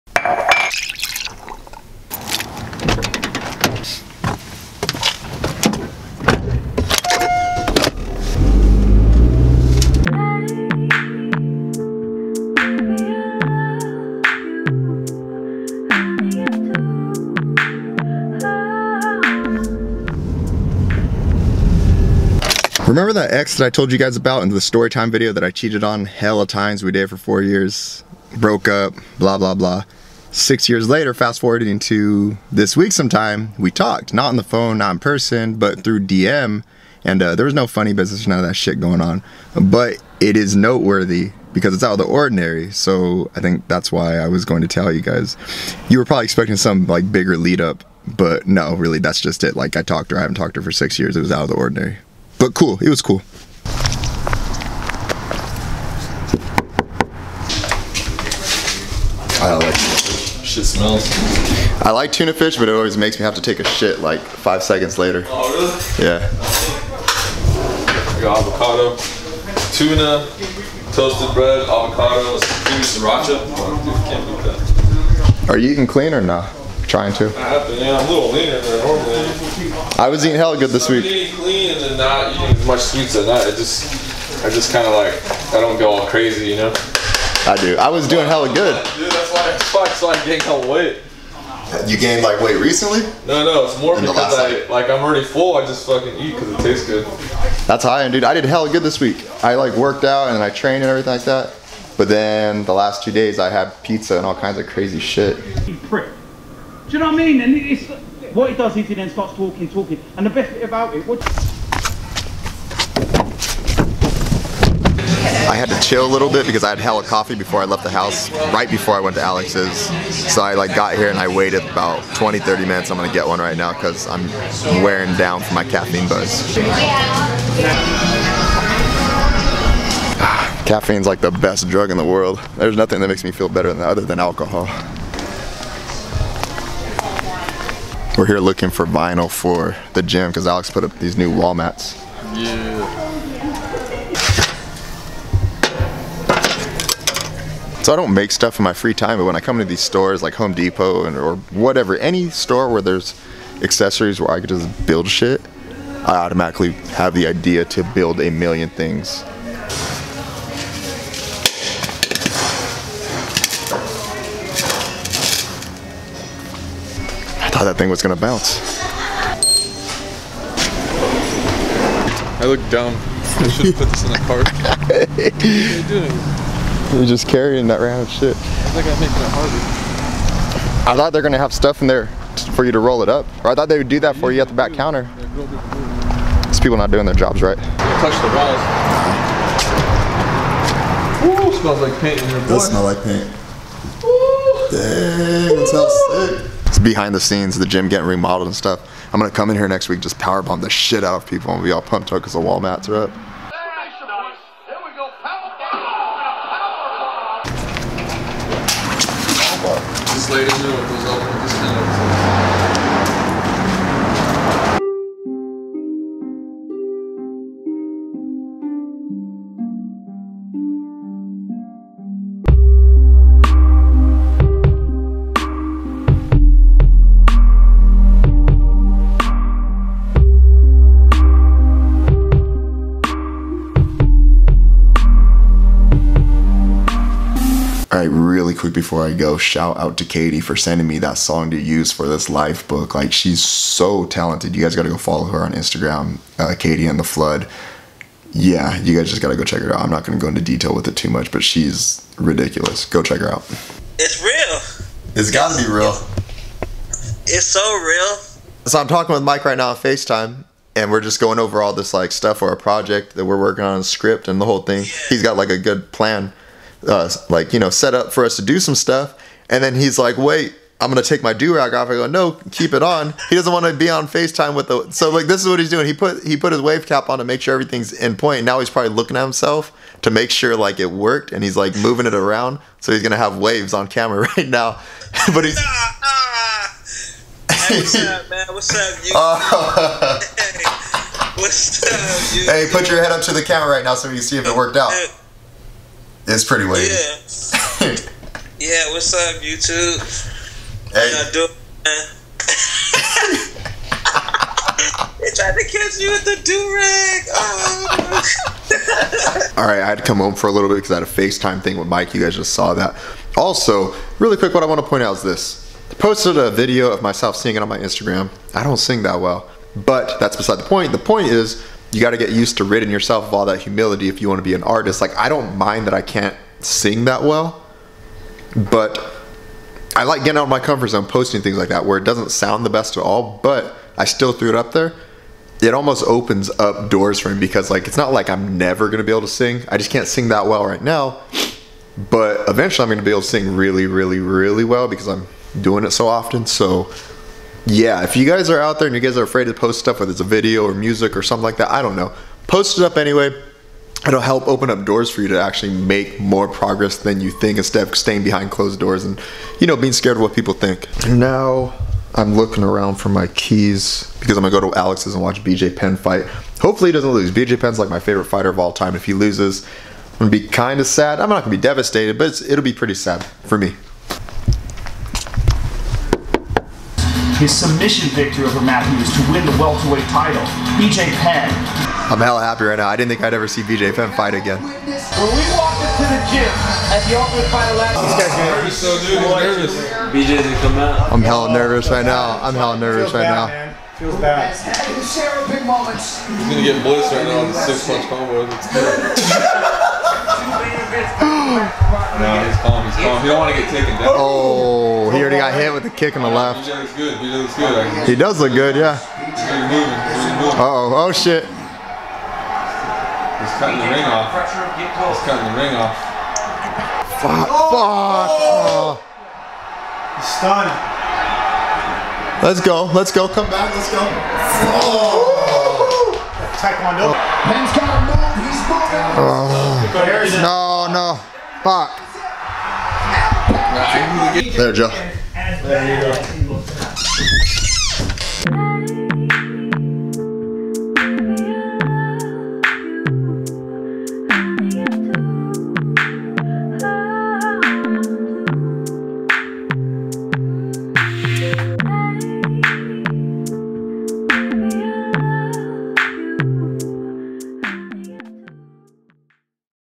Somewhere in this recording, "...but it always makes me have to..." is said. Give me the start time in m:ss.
1:02.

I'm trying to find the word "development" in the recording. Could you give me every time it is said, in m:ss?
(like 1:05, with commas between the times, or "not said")
not said.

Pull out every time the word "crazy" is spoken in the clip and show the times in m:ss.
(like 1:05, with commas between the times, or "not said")
1:26, 1:44.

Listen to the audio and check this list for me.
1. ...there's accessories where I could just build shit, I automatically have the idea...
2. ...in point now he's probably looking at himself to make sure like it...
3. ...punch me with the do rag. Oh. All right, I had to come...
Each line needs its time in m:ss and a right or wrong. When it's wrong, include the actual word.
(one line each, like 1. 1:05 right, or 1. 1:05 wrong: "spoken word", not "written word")
1. 2:32 right
2. 4:37 right
3. 5:05 wrong: "catch", not "punch".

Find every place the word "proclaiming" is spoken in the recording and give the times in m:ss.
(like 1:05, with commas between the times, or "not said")
not said.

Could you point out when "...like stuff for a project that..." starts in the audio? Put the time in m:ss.
4:21.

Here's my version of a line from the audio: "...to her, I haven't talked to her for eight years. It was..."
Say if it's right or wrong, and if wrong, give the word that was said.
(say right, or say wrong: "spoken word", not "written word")
wrong: "six", not "eight".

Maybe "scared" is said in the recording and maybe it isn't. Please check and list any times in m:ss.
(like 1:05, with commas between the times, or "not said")
5:59.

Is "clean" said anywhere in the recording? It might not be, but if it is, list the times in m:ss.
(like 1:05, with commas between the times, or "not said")
1:15, 1:21.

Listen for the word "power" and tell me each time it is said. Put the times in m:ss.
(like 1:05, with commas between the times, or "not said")
3:20.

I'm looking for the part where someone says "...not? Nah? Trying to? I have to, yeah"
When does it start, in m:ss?
1:16.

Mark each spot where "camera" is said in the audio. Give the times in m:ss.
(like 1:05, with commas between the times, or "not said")
4:43, 4:53.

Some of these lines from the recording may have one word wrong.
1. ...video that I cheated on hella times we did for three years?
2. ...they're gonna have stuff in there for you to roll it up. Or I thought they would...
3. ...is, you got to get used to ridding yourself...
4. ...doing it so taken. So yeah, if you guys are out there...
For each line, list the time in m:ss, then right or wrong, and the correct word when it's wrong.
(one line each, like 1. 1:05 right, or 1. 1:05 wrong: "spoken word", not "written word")
1. 0:25 wrong: "four", not "three"
2. 3:01 right
3. 5:21 right
4. 5:45 wrong: "often", not "taken".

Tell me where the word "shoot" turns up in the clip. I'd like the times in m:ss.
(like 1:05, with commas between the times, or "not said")
not said.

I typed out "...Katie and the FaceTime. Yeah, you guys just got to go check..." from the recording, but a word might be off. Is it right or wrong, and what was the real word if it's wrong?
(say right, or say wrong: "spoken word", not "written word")
wrong: "Flood", not "FaceTime".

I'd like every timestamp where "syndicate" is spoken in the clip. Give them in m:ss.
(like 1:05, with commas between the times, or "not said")
not said.